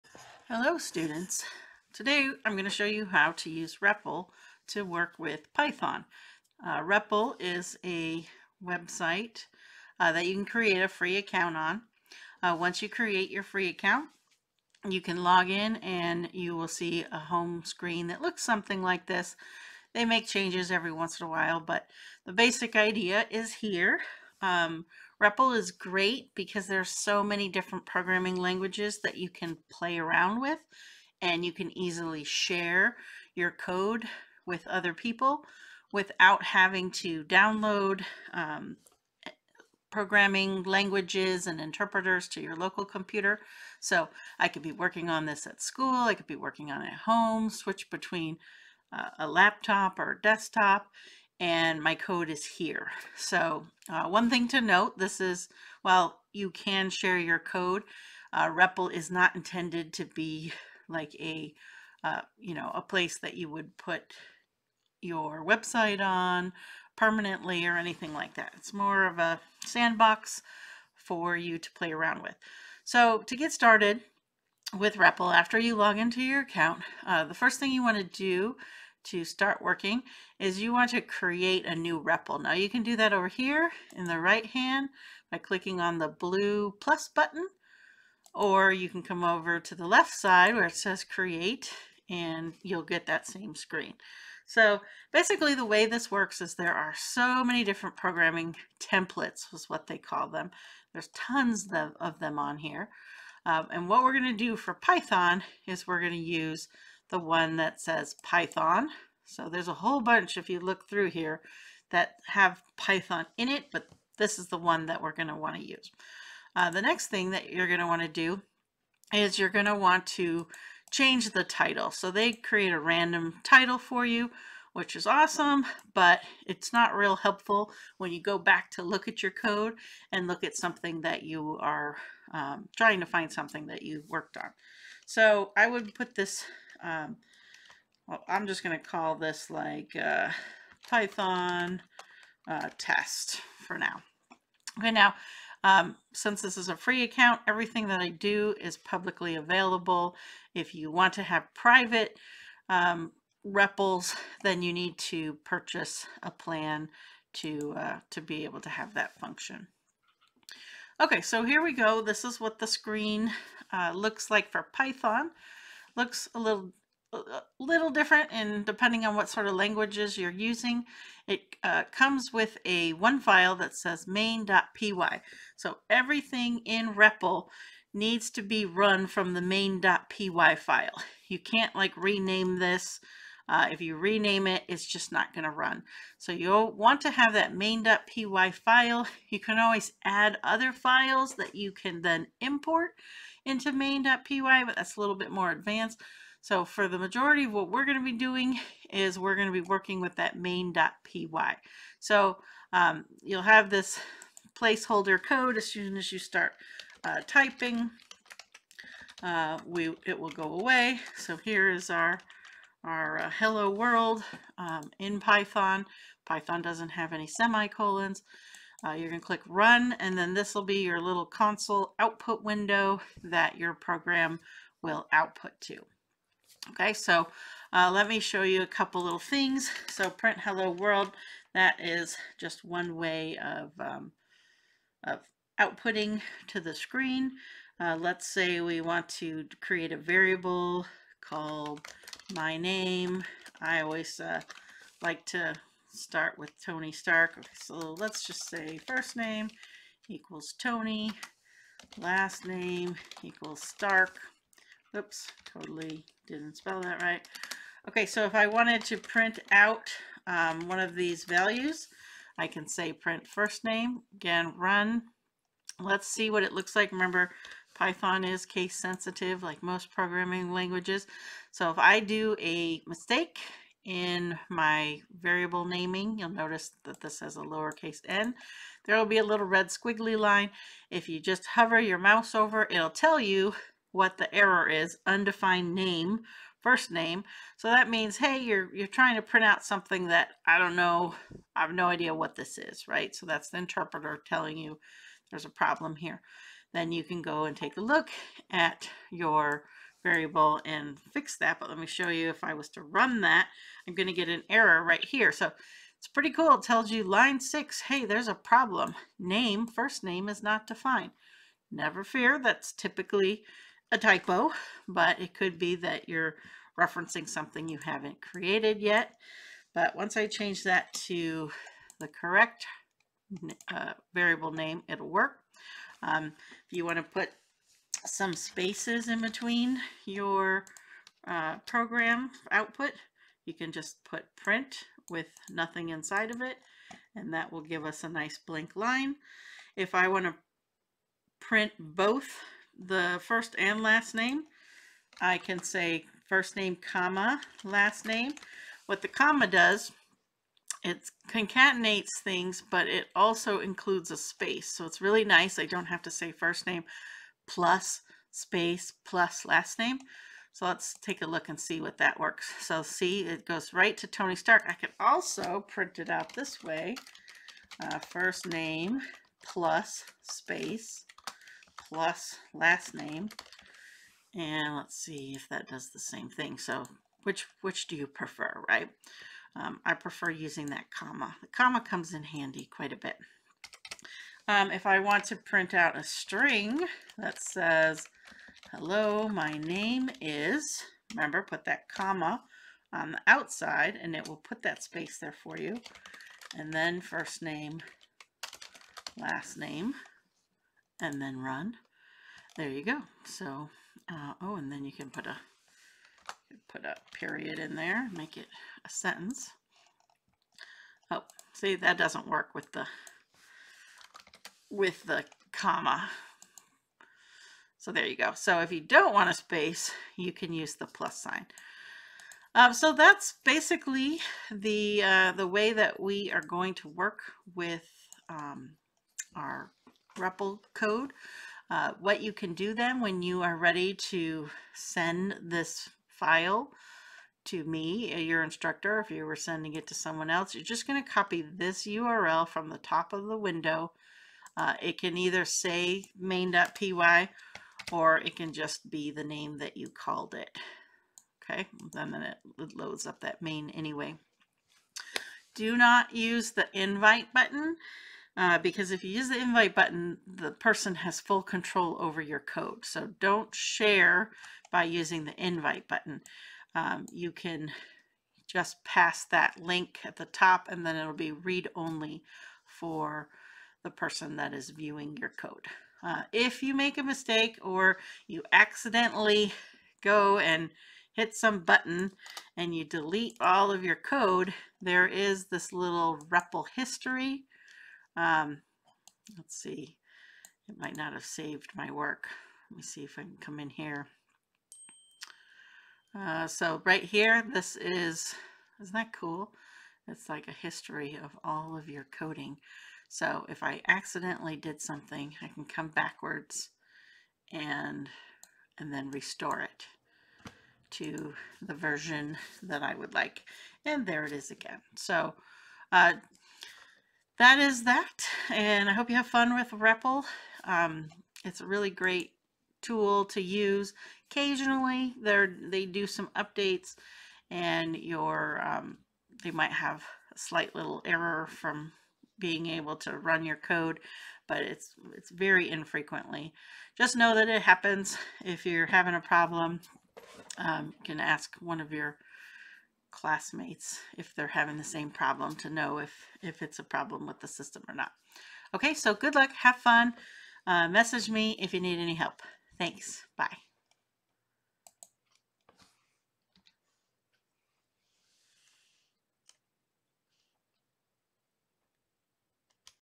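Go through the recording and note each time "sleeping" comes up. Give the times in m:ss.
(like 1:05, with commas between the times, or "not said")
not said.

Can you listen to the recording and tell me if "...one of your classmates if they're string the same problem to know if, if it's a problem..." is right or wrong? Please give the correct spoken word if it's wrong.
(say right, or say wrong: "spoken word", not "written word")
wrong: "having", not "string".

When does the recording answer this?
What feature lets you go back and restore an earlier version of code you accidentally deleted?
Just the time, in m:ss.
8:06.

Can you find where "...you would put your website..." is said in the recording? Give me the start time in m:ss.
1:03.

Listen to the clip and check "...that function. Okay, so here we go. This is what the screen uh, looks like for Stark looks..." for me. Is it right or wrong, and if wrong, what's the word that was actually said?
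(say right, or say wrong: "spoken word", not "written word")
wrong: "Python", not "Stark".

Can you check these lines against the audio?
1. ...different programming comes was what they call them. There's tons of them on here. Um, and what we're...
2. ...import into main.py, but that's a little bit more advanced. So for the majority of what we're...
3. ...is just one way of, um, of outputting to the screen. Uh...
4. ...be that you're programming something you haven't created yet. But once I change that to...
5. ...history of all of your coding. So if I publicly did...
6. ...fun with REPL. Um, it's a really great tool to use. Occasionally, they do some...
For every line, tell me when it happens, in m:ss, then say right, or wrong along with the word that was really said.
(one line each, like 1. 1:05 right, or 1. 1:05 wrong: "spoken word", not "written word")
1. 1:37 wrong: "templates", not "comes"
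2. 3:12 right
3. 3:51 right
4. 5:15 wrong: "referencing", not "programming"
5. 8:20 wrong: "accidentally", not "publicly"
6. 8:39 right.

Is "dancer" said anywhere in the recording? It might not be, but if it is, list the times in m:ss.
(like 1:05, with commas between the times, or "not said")
not said.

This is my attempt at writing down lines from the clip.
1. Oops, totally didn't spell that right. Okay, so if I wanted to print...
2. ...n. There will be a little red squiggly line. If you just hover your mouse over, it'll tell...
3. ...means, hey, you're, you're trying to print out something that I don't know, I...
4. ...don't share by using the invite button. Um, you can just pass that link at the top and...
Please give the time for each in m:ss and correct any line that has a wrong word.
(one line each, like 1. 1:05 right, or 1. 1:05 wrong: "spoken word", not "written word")
1. 4:14 right
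2. 4:38 right
3. 4:47 right
4. 7:43 right.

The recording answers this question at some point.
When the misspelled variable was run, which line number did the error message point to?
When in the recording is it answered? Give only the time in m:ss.
5:07.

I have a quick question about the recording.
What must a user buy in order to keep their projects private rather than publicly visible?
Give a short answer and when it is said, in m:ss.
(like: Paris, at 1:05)
A plan, at 2:35.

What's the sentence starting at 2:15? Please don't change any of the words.
So I would put this um, well, I'm just going to call this like uh, Python uh, test for now.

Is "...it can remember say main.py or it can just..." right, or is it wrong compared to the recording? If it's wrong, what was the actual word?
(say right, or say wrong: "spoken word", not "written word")
wrong: "either", not "remember".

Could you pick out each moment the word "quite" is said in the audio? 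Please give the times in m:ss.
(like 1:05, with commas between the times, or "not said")
6:22.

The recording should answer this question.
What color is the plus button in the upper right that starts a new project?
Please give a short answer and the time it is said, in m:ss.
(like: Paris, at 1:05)
Blue, at 1:26.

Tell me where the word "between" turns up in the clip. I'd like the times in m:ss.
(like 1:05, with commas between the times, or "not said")
0:47, 5:29.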